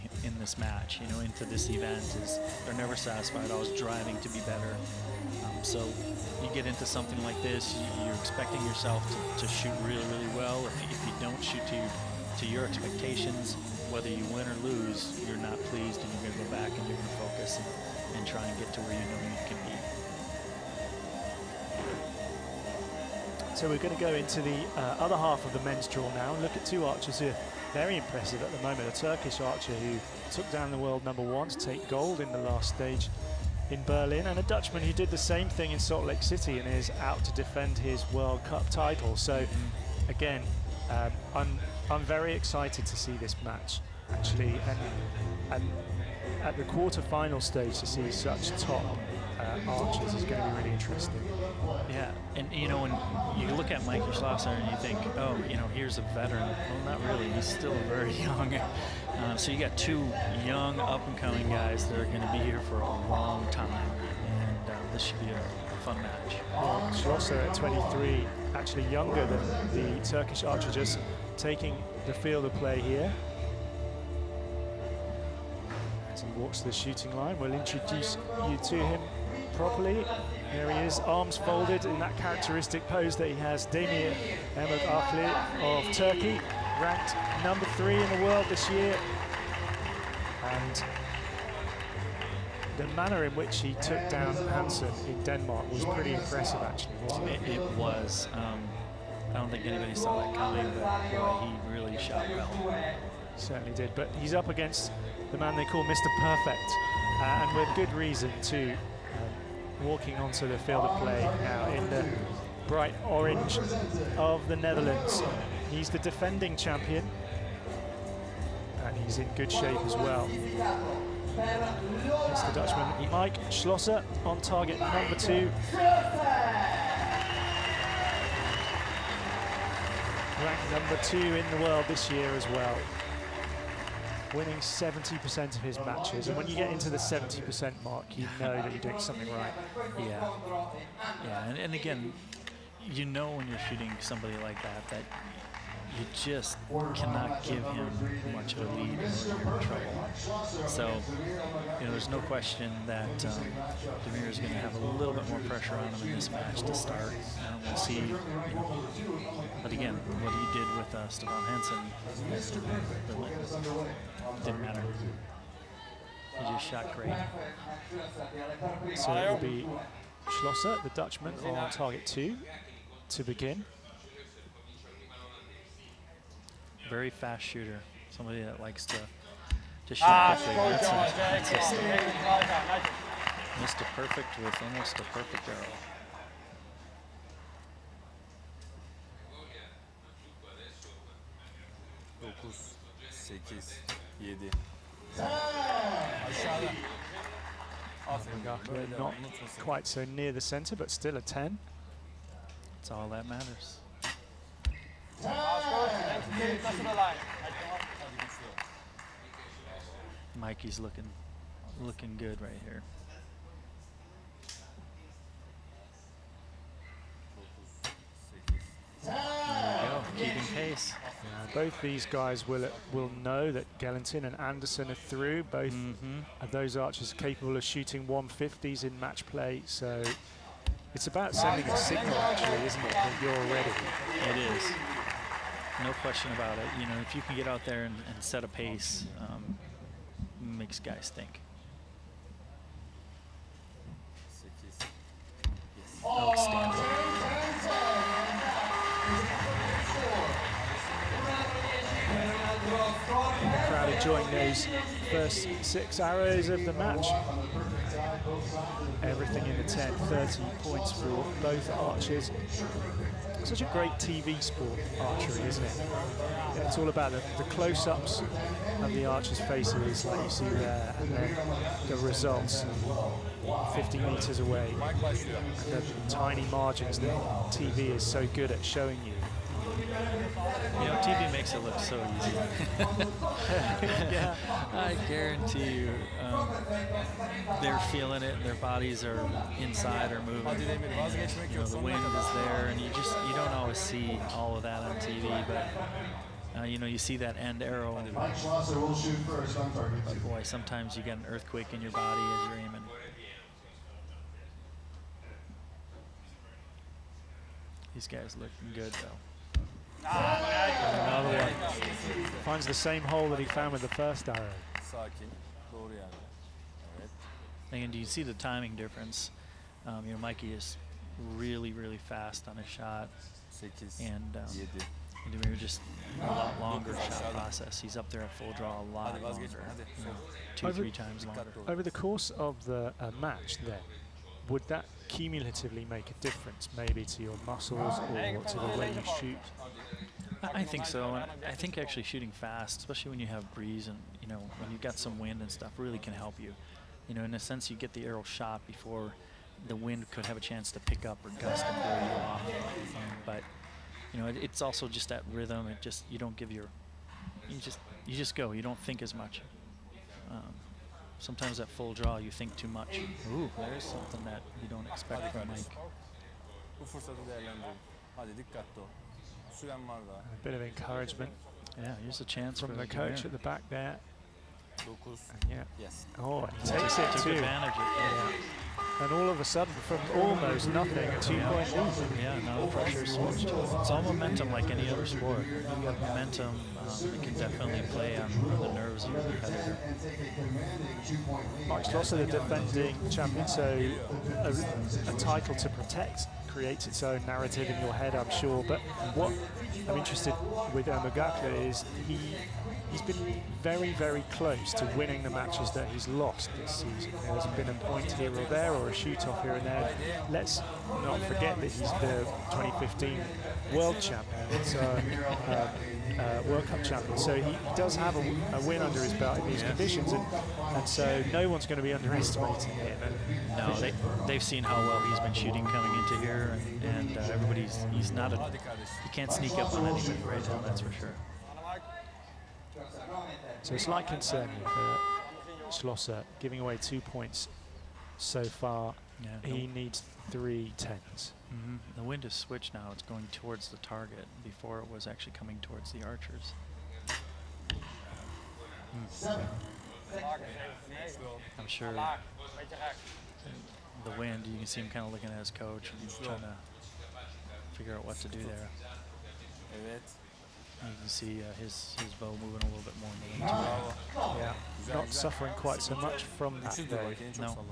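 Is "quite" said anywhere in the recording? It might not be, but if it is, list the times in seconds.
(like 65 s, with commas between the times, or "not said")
199 s, 465 s.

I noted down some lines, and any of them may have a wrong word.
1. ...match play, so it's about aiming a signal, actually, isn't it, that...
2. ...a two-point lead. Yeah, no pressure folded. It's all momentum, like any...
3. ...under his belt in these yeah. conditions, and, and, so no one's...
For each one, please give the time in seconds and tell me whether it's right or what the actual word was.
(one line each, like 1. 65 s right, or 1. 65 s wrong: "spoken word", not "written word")
1. 228 s wrong: "sending", not "aiming"
2. 381 s wrong: "switched", not "folded"
3. 418 s right.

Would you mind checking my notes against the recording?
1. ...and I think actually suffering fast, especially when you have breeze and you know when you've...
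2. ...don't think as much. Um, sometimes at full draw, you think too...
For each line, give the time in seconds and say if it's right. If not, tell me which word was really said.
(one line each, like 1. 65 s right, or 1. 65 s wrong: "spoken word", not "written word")
1. 341 s wrong: "shooting", not "suffering"
2. 358 s right.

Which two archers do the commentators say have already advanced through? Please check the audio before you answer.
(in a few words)
Gellenthien and Anderson.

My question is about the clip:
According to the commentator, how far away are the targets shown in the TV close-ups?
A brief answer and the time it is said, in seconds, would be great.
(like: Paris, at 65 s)
50 metres, at 273 s.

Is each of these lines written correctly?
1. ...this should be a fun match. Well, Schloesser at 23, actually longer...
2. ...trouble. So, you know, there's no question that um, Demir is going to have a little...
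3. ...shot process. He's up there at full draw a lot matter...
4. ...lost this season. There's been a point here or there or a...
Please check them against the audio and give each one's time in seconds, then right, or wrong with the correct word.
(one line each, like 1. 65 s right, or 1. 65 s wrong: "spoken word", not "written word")
1. 64 s wrong: "younger", not "longer"
2. 149 s right
3. 326 s wrong: "longer", not "matter"
4. 406 s right.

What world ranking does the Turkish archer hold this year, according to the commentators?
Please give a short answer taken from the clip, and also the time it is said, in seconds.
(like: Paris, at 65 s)
3, at 87 s.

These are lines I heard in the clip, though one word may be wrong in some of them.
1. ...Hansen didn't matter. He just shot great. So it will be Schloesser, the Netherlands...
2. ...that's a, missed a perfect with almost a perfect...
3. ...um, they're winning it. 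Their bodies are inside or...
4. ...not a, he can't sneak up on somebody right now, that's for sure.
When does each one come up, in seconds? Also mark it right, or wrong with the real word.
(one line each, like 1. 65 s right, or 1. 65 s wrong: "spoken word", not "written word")
1. 161 s wrong: "Dutchman", not "Netherlands"
2. 181 s right
3. 286 s wrong: "feeling", not "winning"
4. 428 s wrong: "anybody", not "somebody".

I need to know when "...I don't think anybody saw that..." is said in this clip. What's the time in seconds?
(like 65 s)
99 s.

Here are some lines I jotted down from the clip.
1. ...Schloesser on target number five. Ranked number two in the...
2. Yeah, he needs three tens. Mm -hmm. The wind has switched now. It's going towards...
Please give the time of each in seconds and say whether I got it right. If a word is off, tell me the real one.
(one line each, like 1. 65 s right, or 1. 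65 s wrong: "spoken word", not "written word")
1. 123 s wrong: "two", not "five"
2. 439 s right.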